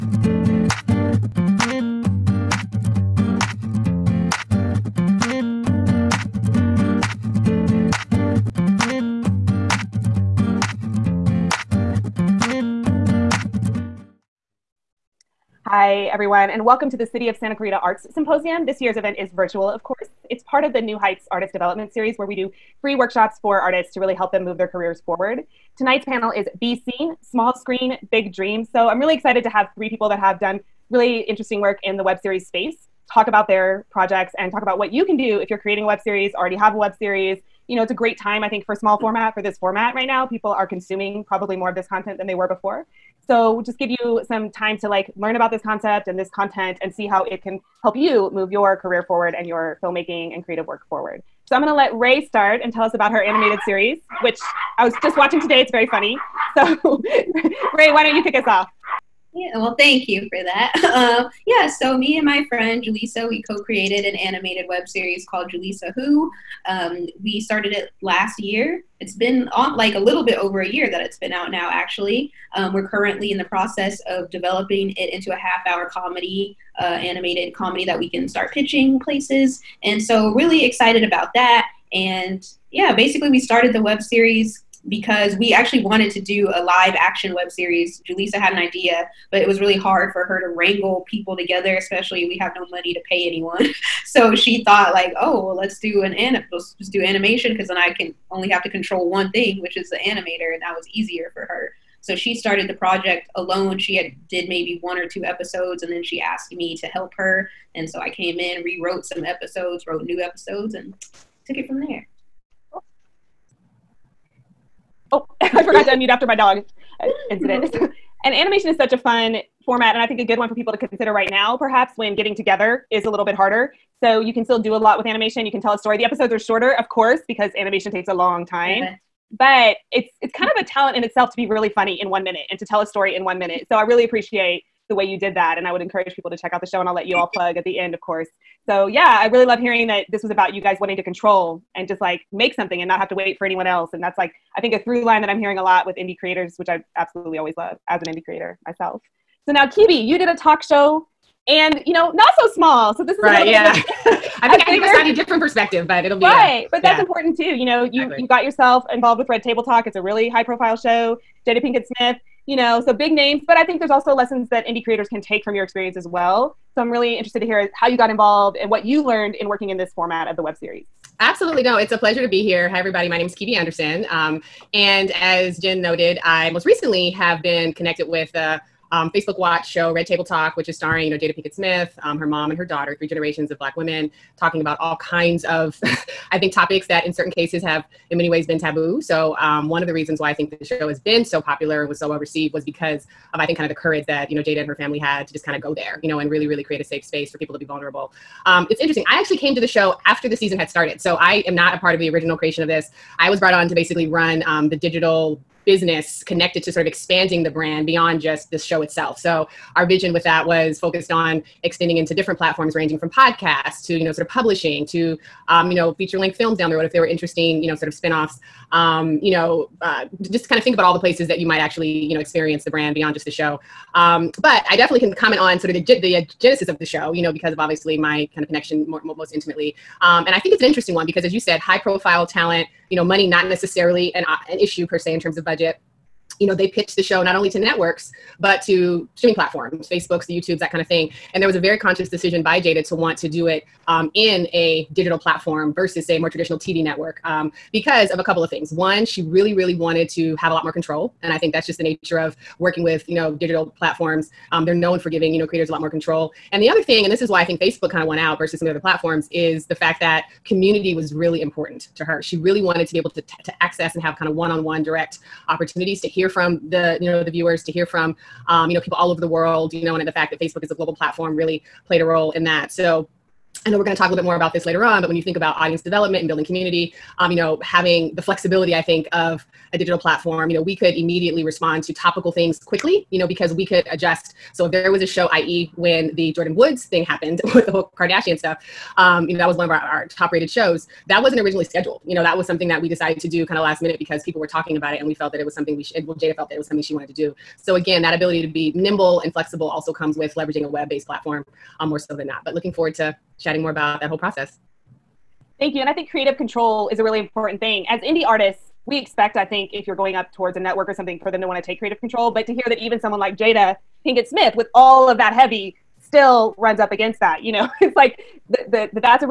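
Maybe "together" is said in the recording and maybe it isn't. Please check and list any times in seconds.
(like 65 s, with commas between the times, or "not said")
91 s, 122 s.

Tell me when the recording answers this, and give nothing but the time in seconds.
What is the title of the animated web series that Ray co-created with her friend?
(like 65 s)
65 s.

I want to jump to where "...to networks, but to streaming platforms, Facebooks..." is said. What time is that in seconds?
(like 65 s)
237 s.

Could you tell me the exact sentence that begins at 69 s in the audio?
It's been on, like a little bit over a year that it's been out now, actually.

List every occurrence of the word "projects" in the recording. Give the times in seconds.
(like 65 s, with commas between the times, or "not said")
33 s, 102 s.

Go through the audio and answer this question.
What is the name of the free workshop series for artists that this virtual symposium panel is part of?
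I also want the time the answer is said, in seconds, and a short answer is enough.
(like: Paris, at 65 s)
New Heights Artist Development Series, at 20 s.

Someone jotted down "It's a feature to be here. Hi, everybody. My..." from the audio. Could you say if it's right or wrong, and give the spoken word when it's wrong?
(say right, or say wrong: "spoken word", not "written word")
wrong: "pleasure", not "feature".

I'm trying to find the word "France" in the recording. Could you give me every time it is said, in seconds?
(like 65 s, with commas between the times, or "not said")
not said.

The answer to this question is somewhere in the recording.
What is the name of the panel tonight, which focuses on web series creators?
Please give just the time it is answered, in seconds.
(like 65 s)
26 s.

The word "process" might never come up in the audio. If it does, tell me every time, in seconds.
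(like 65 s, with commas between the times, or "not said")
73 s, 304 s.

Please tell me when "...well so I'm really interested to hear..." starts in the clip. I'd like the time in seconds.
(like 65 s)
166 s.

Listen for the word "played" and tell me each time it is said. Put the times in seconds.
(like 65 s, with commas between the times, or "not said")
271 s.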